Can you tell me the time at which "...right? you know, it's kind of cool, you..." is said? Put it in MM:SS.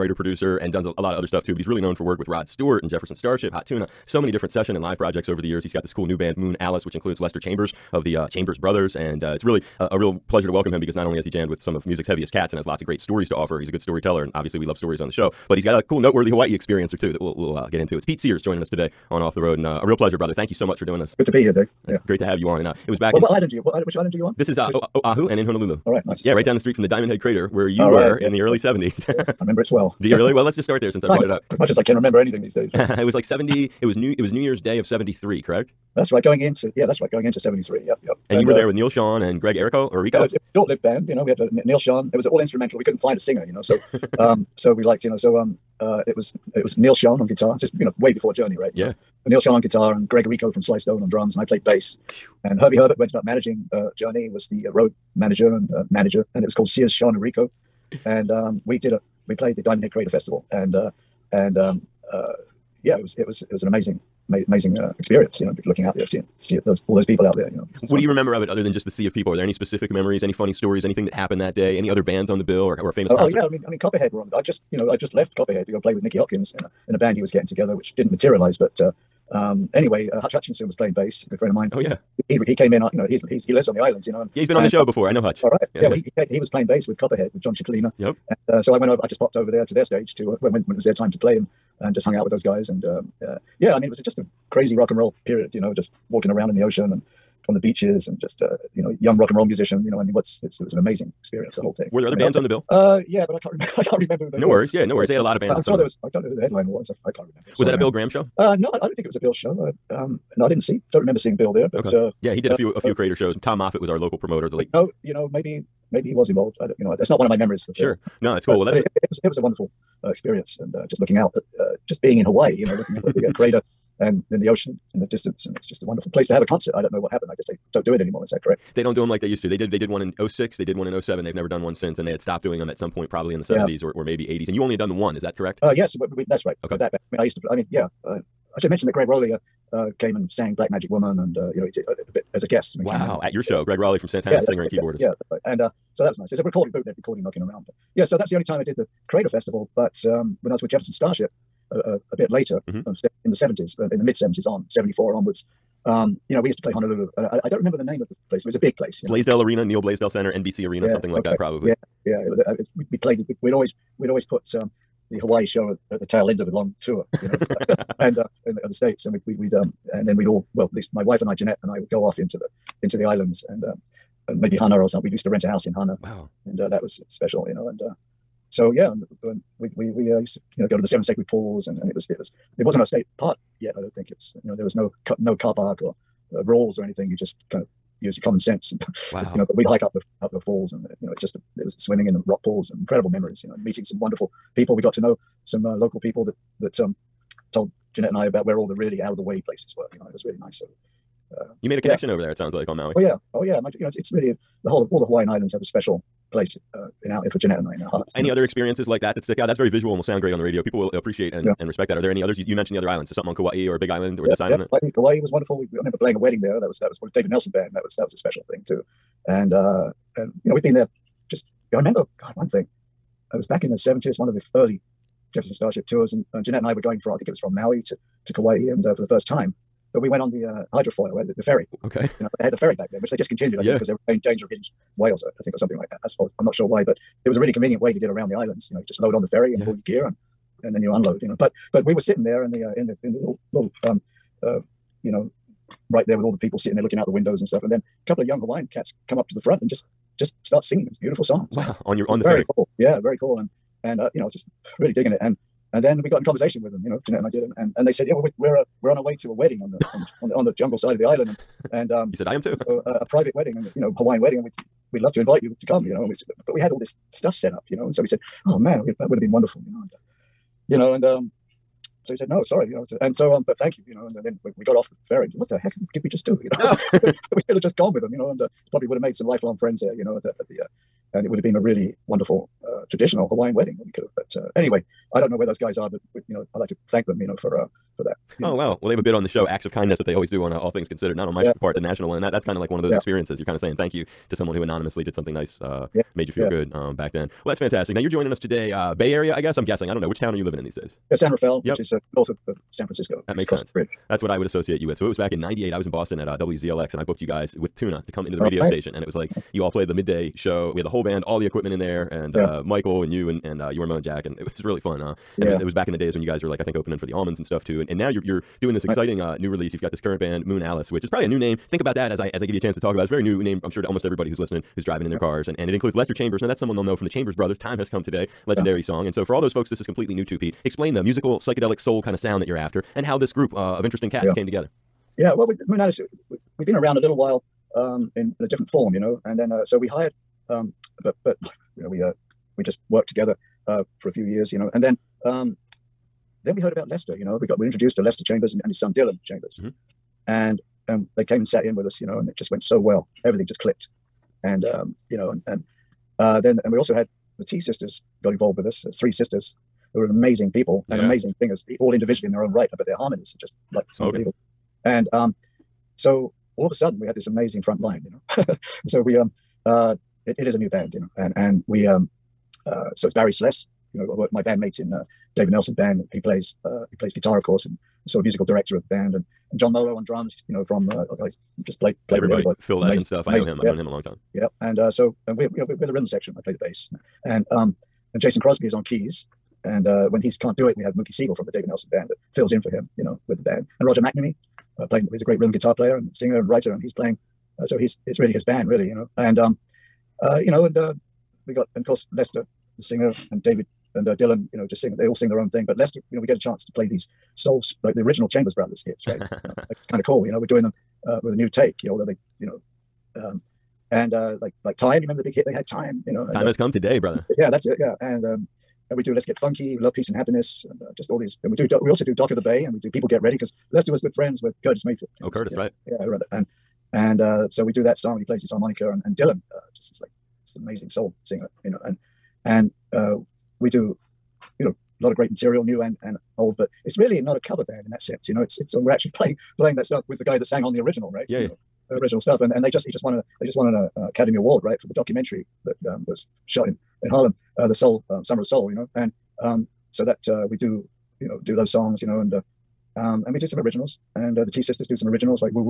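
06:49.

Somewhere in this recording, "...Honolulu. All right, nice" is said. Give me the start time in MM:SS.
00:25.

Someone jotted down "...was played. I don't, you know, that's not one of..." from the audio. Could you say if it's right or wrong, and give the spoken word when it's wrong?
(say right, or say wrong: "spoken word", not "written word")
wrong: "involved", not "played".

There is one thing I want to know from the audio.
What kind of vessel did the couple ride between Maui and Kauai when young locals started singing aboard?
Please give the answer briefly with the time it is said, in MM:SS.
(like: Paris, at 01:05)
Hydrofoil, at 03:50.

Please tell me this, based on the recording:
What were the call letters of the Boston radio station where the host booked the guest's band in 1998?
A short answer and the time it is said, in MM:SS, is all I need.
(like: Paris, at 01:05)
WZLX, at 05:06.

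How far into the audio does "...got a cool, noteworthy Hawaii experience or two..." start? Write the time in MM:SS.
00:15.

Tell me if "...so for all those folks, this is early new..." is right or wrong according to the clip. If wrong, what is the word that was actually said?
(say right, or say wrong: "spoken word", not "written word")
wrong: "completely", not "early".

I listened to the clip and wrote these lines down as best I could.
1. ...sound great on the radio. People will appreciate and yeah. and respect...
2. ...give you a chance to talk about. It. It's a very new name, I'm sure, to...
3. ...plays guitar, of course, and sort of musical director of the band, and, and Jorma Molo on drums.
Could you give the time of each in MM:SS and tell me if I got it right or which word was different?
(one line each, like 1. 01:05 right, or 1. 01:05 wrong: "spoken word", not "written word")
1. 03:30 right
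2. 05:22 right
3. 06:16 wrong: "John", not "Jorma".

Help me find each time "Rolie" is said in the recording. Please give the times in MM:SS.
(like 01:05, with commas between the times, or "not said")
02:19, 02:23.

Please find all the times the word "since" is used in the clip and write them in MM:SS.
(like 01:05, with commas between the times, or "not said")
00:30, 02:11.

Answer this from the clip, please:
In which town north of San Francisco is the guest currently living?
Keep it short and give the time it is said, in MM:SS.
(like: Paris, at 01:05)
San Rafael, at 05:01.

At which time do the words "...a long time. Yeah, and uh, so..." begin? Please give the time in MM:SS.
06:23.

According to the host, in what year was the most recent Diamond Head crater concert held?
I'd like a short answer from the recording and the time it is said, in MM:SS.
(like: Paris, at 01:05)
2007, at 02:11.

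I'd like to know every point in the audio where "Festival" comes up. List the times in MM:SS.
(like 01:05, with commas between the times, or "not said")
01:00, 02:29.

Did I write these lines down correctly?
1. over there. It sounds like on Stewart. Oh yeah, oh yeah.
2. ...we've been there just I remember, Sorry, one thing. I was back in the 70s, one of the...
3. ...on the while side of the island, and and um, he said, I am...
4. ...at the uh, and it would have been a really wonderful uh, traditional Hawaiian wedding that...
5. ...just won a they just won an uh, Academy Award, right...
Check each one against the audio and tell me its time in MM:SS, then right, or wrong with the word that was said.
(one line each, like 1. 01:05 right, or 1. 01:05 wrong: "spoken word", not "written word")
1. 03:22 wrong: "Maui", not "Stewart"
2. 03:40 wrong: "God", not "Sorry"
3. 04:20 wrong: "jungle", not "while"
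4. 04:40 right
5. 07:22 right.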